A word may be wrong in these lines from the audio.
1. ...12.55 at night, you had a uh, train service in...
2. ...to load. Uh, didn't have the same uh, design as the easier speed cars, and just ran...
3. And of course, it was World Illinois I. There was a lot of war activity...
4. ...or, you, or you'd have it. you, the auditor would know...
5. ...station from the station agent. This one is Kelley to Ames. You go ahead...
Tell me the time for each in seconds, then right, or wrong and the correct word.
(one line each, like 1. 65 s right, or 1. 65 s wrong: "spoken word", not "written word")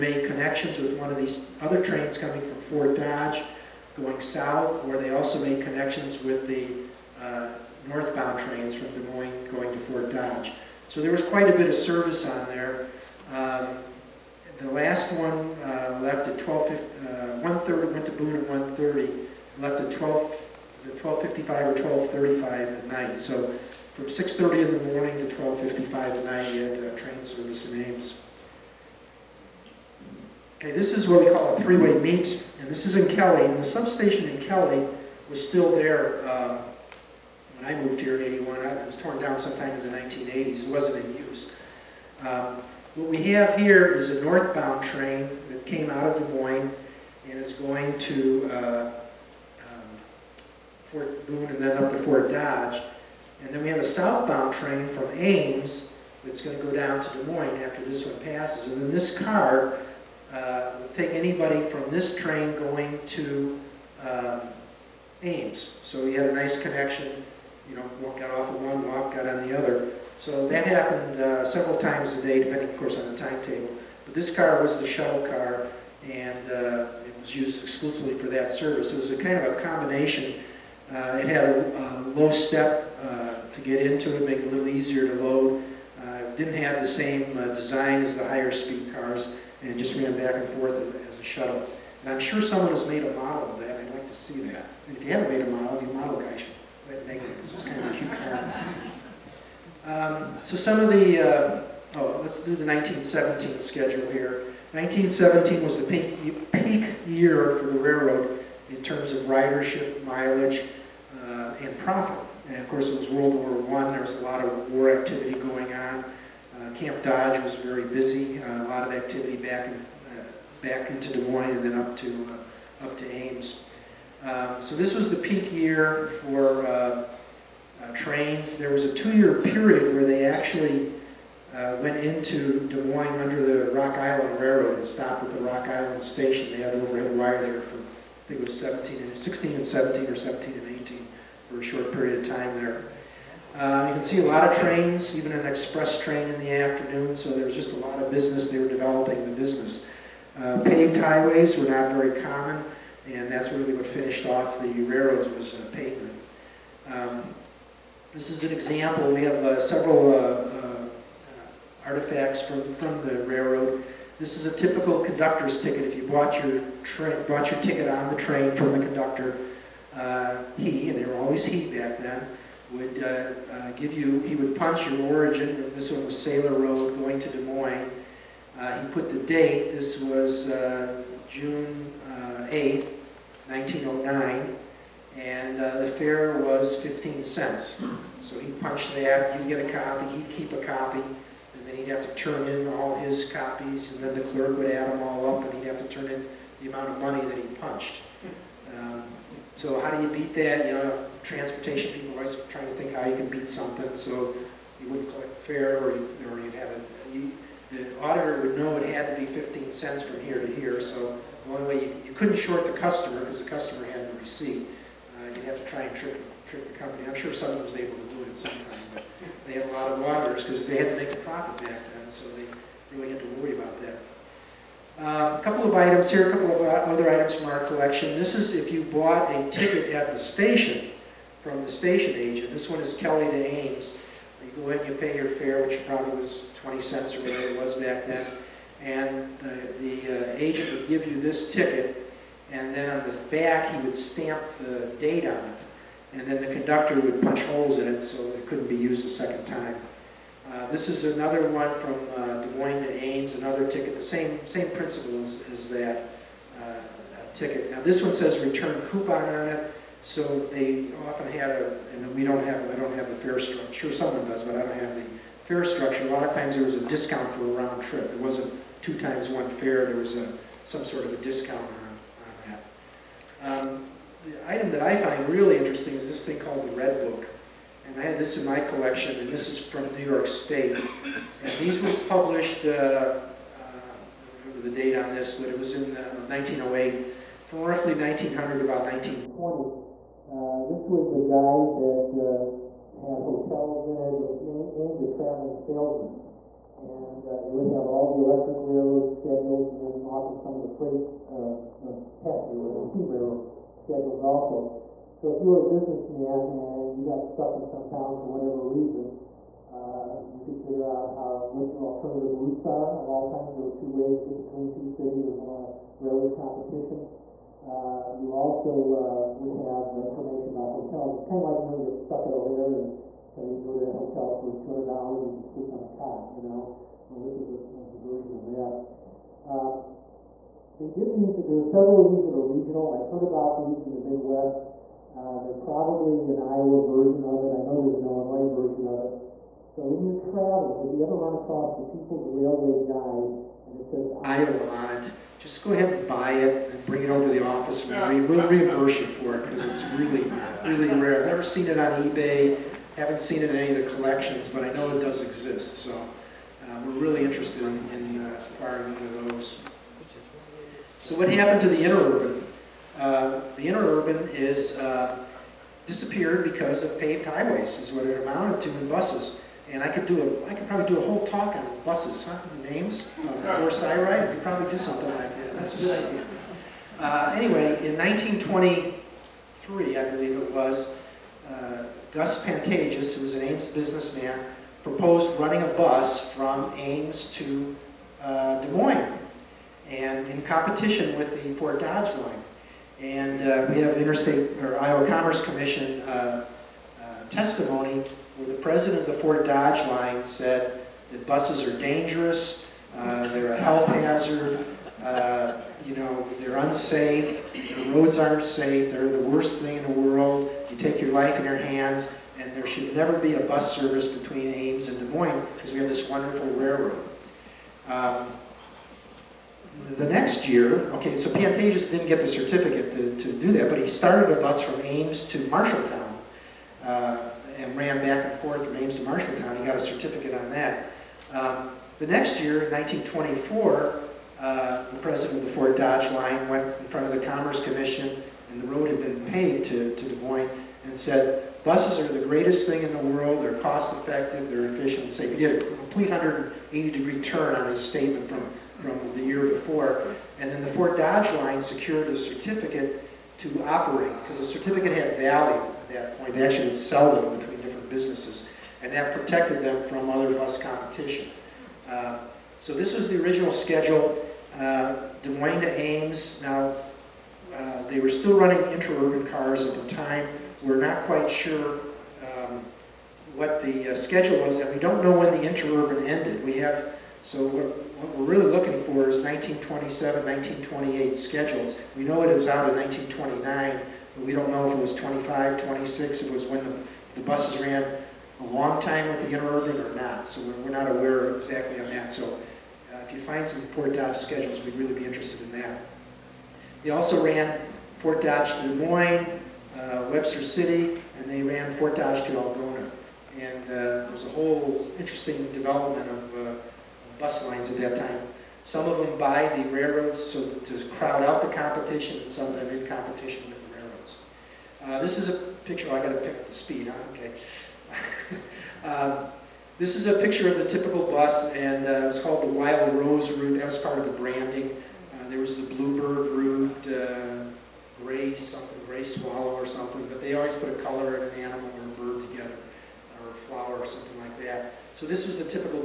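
1. 25 s right
2. 85 s wrong: "higher", not "easier"
3. 112 s wrong: "War", not "Illinois"
4. 205 s right
5. 230 s right.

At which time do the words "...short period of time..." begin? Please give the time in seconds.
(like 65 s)
141 s.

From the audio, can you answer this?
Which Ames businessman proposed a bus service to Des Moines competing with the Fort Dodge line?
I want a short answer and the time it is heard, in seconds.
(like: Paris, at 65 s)
Gus Pantages, at 382 s.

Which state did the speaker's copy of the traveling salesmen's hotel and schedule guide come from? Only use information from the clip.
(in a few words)
New York.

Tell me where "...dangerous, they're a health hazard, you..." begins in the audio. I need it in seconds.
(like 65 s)
401 s.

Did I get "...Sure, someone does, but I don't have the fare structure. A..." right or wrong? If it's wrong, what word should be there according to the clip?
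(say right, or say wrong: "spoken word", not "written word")
right.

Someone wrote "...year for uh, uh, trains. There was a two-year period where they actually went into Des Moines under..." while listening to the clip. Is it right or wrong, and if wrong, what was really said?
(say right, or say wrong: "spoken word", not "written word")
right.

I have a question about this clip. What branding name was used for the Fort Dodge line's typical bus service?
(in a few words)
Wild Rose Route.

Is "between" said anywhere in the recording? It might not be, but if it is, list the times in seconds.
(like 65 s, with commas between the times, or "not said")
314 s, 414 s, 457 s.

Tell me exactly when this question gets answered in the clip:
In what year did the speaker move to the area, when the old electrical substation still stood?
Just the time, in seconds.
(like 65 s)
38 s.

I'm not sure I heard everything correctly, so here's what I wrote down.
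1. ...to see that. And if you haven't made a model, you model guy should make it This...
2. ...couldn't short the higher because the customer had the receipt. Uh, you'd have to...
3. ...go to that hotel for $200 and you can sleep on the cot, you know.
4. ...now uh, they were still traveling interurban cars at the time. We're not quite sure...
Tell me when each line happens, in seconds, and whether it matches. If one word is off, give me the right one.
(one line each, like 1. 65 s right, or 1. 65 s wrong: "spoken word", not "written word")
1. 94 s right
2. 212 s wrong: "customer", not "higher"
3. 323 s right
4. 466 s wrong: "running", not "traveling".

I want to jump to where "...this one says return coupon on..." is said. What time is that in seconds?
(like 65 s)
257 s.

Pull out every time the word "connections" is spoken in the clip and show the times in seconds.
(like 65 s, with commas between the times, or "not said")
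0 s, 5 s, 66 s.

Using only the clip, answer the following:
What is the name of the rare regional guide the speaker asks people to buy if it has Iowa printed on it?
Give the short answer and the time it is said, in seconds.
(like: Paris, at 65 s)
People's Railway Guide, at 341 s.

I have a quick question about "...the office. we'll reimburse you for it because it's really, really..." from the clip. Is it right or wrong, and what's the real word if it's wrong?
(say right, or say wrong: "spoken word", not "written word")
right.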